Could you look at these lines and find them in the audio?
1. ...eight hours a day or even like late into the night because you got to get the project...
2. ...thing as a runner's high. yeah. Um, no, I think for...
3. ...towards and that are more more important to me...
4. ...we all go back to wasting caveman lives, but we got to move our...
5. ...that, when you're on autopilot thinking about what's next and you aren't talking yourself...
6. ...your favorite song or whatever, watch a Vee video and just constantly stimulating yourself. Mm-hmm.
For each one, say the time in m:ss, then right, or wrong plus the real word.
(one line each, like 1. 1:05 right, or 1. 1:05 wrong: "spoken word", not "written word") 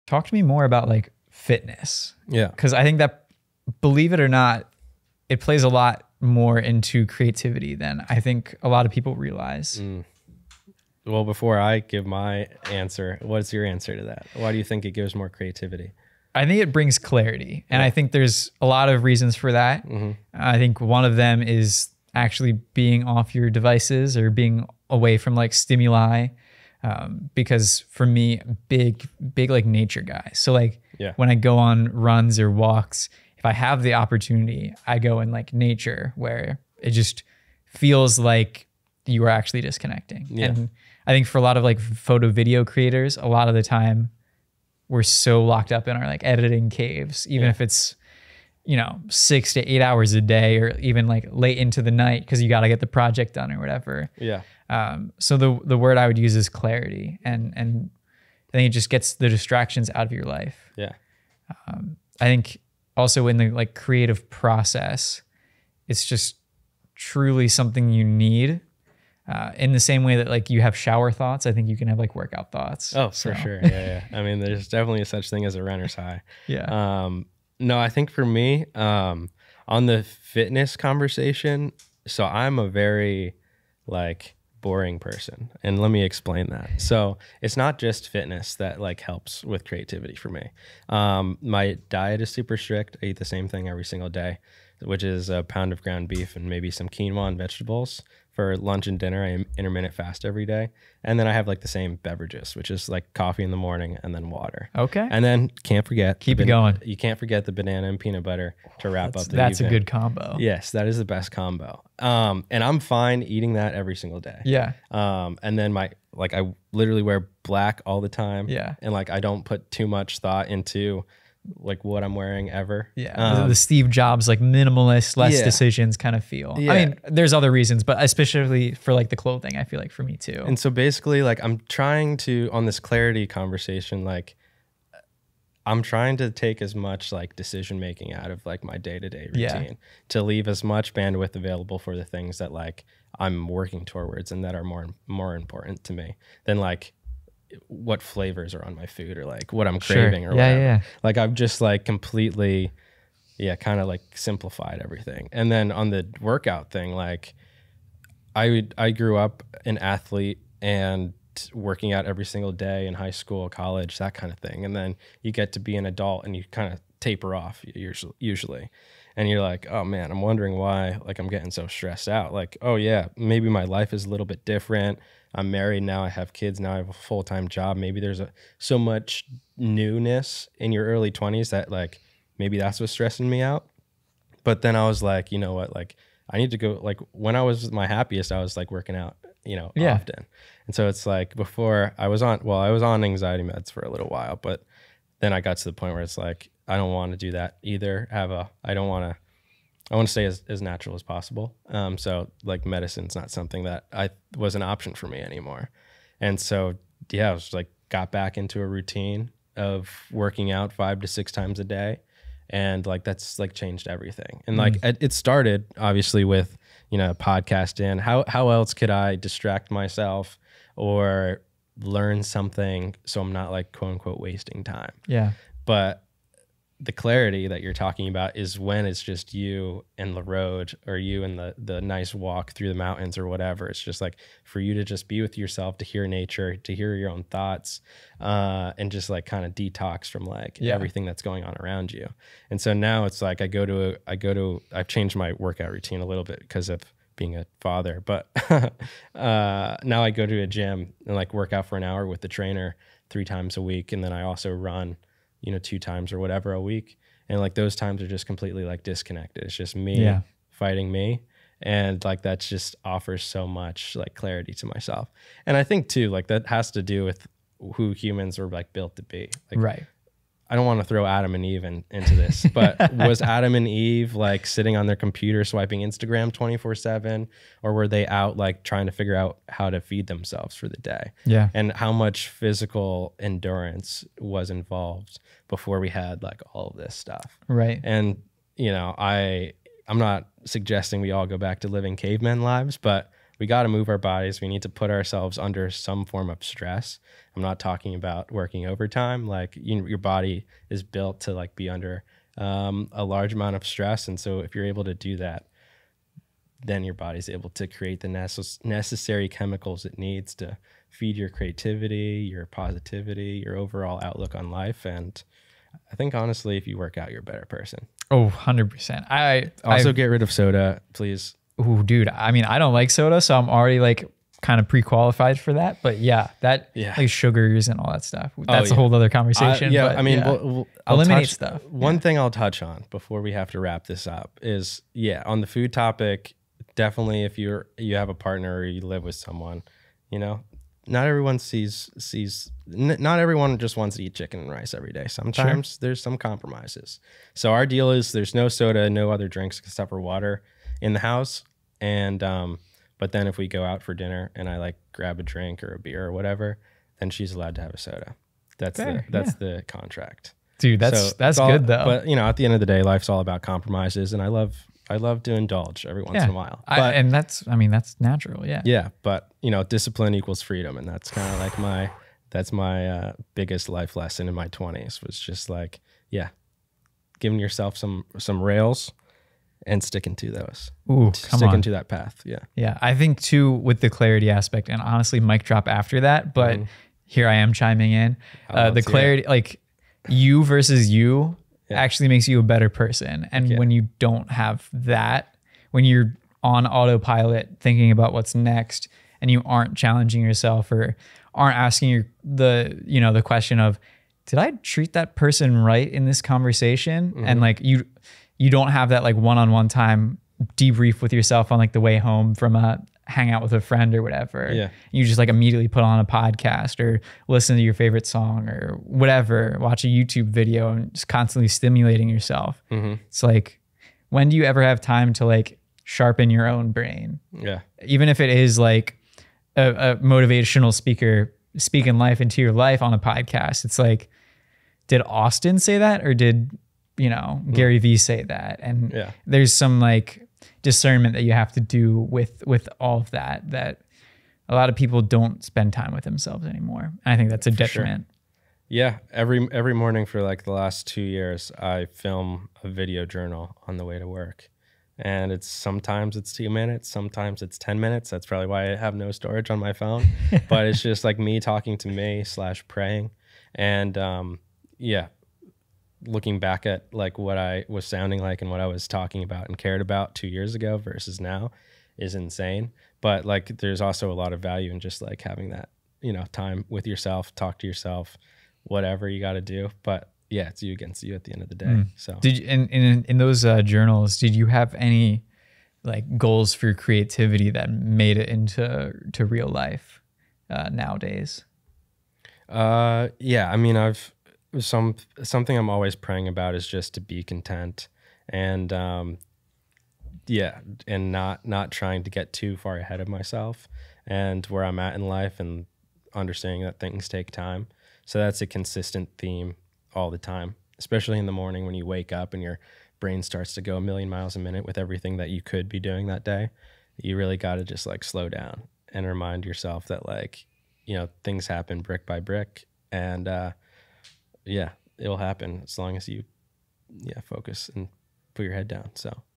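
1. 0:49 right
2. 1:15 right
3. 2:23 right
4. 4:50 wrong: "living", not "wasting"
5. 6:34 wrong: "challenging", not "talking"
6. 6:57 wrong: "YouTube", not "Vee".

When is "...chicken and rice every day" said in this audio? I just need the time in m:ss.
5:44.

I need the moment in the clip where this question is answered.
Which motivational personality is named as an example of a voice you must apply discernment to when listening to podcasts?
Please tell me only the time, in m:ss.
7:17.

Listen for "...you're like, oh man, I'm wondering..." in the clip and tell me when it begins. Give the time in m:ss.
2:49.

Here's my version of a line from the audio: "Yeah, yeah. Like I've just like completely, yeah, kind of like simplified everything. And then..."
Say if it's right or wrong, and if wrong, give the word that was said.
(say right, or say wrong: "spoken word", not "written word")
right.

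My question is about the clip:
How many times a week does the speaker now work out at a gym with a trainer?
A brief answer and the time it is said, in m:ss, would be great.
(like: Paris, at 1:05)
3, at 4:13.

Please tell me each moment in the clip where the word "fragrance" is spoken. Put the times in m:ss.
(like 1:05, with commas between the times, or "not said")
not said.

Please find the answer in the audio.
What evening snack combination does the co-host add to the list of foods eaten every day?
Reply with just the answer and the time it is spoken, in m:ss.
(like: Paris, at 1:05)
Banana and peanut butter, at 1:47.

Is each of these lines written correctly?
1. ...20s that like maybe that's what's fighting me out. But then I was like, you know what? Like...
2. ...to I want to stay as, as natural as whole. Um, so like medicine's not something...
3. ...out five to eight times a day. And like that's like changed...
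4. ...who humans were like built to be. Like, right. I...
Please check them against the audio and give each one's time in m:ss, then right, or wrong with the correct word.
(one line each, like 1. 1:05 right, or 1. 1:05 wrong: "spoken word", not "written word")
1. 3:01 wrong: "stressing", not "fighting"
2. 3:19 wrong: "possible", not "whole"
3. 3:30 wrong: "six", not "eight"
4. 4:27 right.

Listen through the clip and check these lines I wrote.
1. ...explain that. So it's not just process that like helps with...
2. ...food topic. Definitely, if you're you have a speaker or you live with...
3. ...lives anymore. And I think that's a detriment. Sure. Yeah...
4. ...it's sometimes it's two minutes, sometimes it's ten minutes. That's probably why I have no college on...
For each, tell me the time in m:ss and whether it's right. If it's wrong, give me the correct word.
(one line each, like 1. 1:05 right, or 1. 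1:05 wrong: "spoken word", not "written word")
1. 1:26 wrong: "fitness", not "process"
2. 5:35 wrong: "partner", not "speaker"
3. 7:26 wrong: "themselves", not "lives"
4. 7:35 wrong: "storage", not "college".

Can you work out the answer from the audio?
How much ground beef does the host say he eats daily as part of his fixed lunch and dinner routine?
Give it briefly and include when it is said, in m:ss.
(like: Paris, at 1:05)
1 pound, at 1:35.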